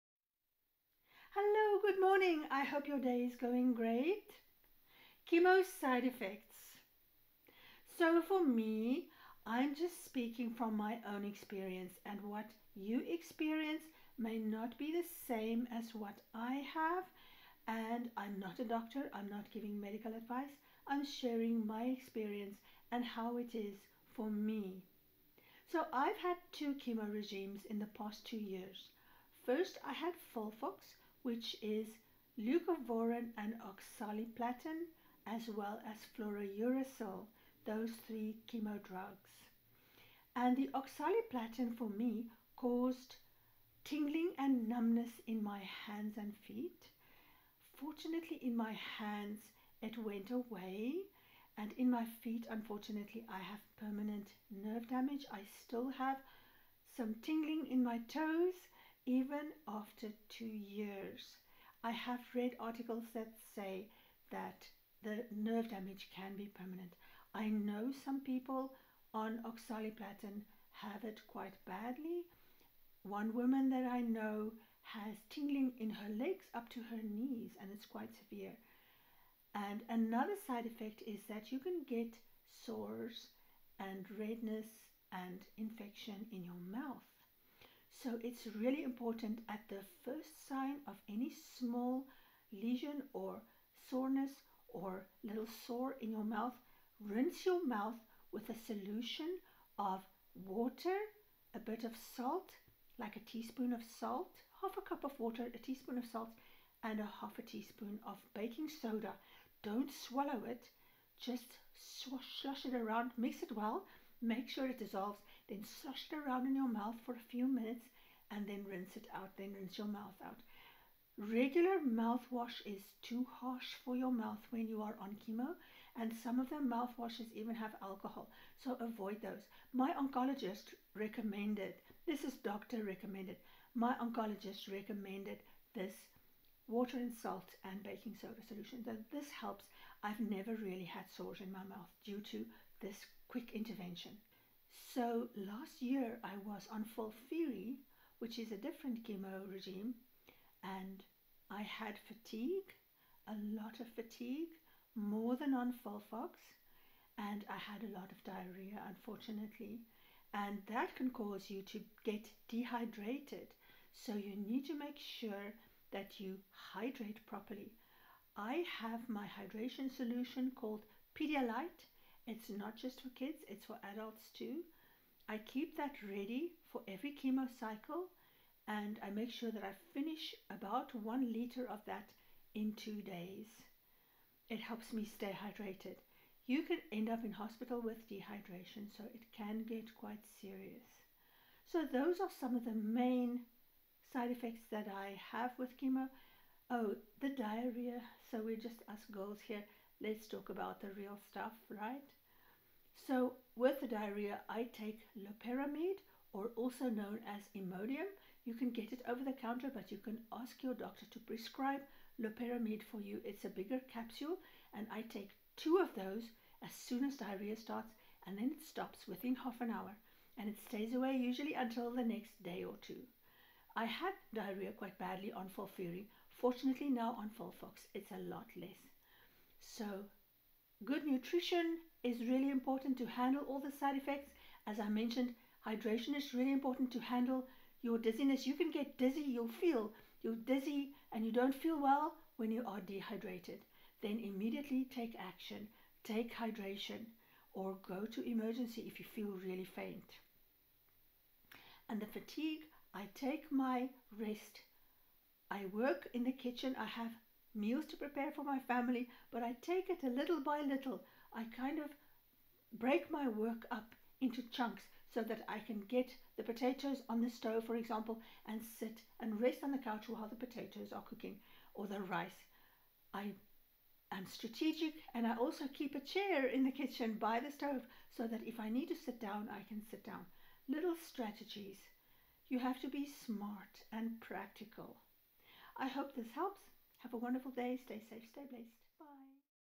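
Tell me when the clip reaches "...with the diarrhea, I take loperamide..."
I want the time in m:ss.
3:23.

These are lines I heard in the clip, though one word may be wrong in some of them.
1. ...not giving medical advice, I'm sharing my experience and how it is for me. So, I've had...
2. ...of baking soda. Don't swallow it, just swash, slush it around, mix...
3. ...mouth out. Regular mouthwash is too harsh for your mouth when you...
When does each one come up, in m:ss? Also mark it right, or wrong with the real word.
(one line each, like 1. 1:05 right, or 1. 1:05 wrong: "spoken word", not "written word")
1. 0:19 right
2. 1:48 right
3. 1:59 right.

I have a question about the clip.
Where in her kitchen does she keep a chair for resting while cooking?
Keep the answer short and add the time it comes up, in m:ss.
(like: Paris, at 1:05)
by the stove, at 4:37.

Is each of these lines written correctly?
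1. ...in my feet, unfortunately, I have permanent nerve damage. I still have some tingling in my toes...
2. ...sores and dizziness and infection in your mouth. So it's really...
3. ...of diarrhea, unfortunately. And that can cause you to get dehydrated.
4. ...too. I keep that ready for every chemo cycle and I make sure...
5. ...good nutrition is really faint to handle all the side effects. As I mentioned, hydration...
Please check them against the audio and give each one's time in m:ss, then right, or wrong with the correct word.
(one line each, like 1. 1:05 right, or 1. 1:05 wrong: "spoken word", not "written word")
1. 0:51 right
2. 1:22 wrong: "redness", not "dizziness"
3. 2:38 right
4. 2:54 right
5. 3:50 wrong: "important", not "faint".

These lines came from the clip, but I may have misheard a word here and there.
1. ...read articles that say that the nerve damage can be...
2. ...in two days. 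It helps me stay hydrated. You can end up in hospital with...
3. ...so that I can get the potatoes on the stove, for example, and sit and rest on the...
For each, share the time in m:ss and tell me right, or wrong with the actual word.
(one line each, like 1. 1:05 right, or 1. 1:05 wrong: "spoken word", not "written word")
1. 1:02 right
2. 3:02 right
3. 4:25 right.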